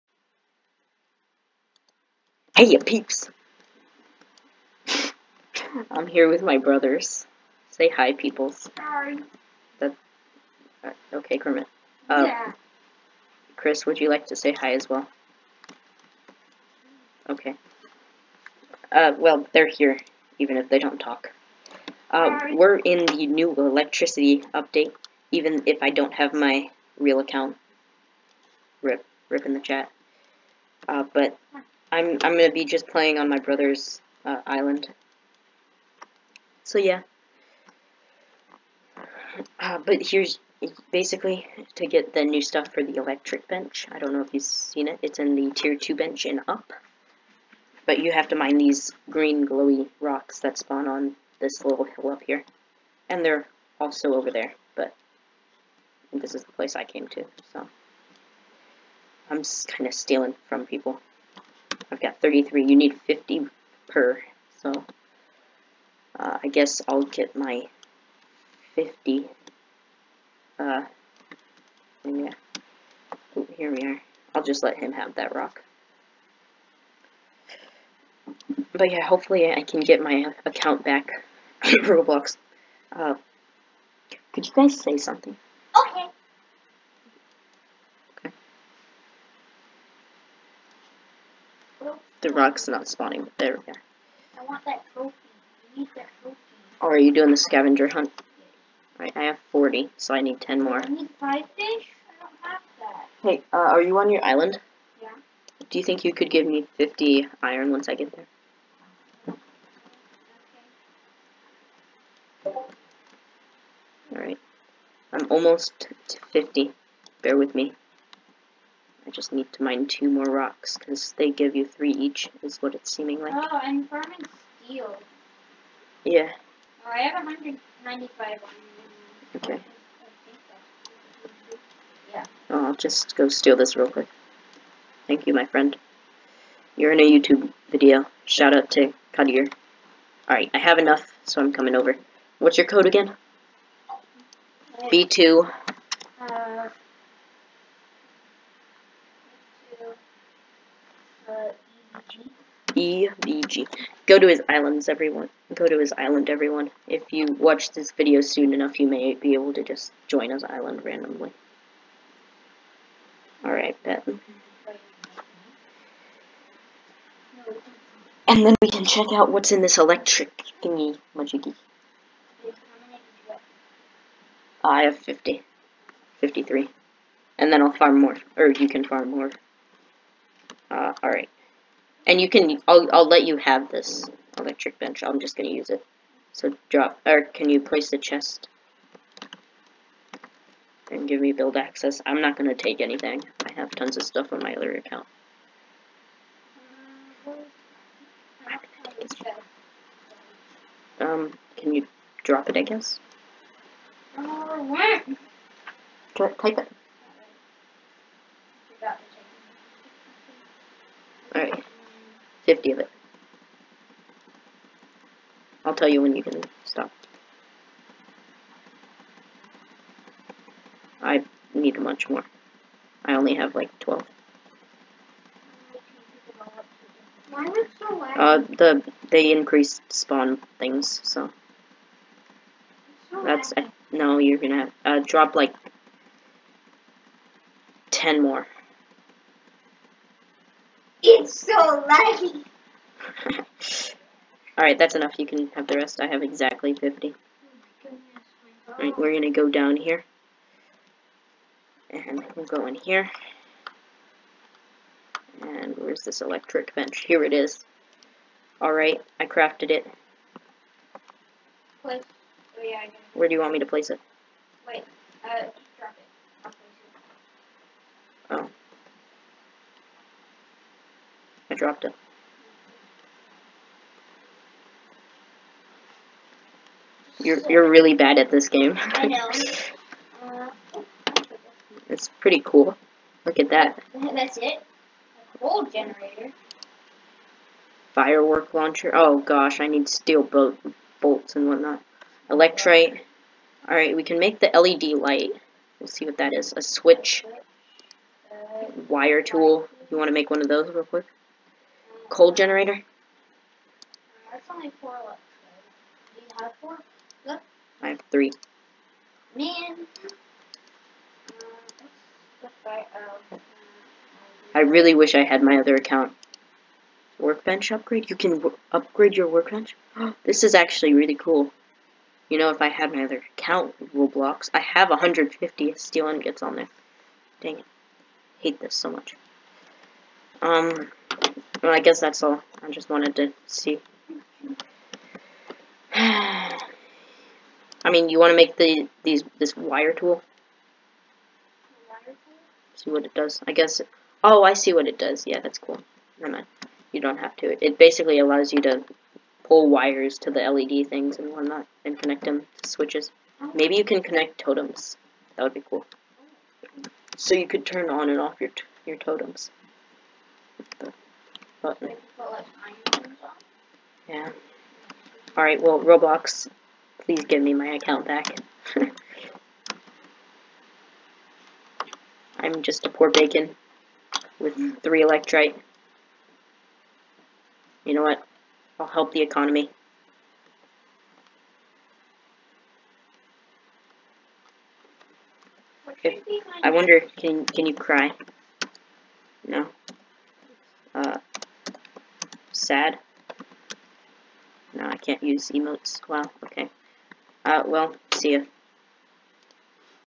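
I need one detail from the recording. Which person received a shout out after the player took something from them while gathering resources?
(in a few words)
Kadir.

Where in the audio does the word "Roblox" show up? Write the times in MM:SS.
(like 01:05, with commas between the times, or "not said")
01:21, 05:23, 06:05.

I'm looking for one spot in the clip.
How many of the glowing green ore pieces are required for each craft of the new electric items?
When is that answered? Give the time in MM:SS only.
01:02.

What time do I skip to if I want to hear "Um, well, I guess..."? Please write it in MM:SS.
05:30.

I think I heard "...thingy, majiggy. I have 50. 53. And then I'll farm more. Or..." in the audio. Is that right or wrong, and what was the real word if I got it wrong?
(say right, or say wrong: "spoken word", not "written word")
right.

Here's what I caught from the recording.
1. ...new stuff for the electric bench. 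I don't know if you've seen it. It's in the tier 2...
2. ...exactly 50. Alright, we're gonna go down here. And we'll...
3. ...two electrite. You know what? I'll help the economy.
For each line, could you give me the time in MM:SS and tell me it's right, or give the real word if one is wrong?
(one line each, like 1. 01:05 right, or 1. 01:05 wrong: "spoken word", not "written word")
1. 00:42 right
2. 04:06 right
3. 06:14 wrong: "three", not "two".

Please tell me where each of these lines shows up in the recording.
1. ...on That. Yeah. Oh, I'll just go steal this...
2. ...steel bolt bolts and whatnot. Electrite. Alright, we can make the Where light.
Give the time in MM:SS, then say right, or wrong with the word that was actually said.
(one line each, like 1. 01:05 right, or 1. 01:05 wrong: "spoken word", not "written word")
1. 02:08 wrong: "Okay", not "That"
2. 04:49 wrong: "LED", not "Where".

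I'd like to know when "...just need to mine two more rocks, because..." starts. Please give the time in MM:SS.
01:59.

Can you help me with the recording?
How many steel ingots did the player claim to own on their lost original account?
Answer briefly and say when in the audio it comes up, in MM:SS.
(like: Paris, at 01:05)
150, at 05:24.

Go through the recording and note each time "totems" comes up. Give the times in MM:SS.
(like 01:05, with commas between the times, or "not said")
05:54, 05:58.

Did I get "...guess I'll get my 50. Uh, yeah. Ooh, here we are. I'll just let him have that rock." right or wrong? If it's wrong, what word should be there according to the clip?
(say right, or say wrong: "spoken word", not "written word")
right.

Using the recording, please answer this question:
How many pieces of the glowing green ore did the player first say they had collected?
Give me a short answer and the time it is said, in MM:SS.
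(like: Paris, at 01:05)
33, at 01:01.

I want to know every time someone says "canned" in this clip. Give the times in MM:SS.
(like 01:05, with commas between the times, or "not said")
not said.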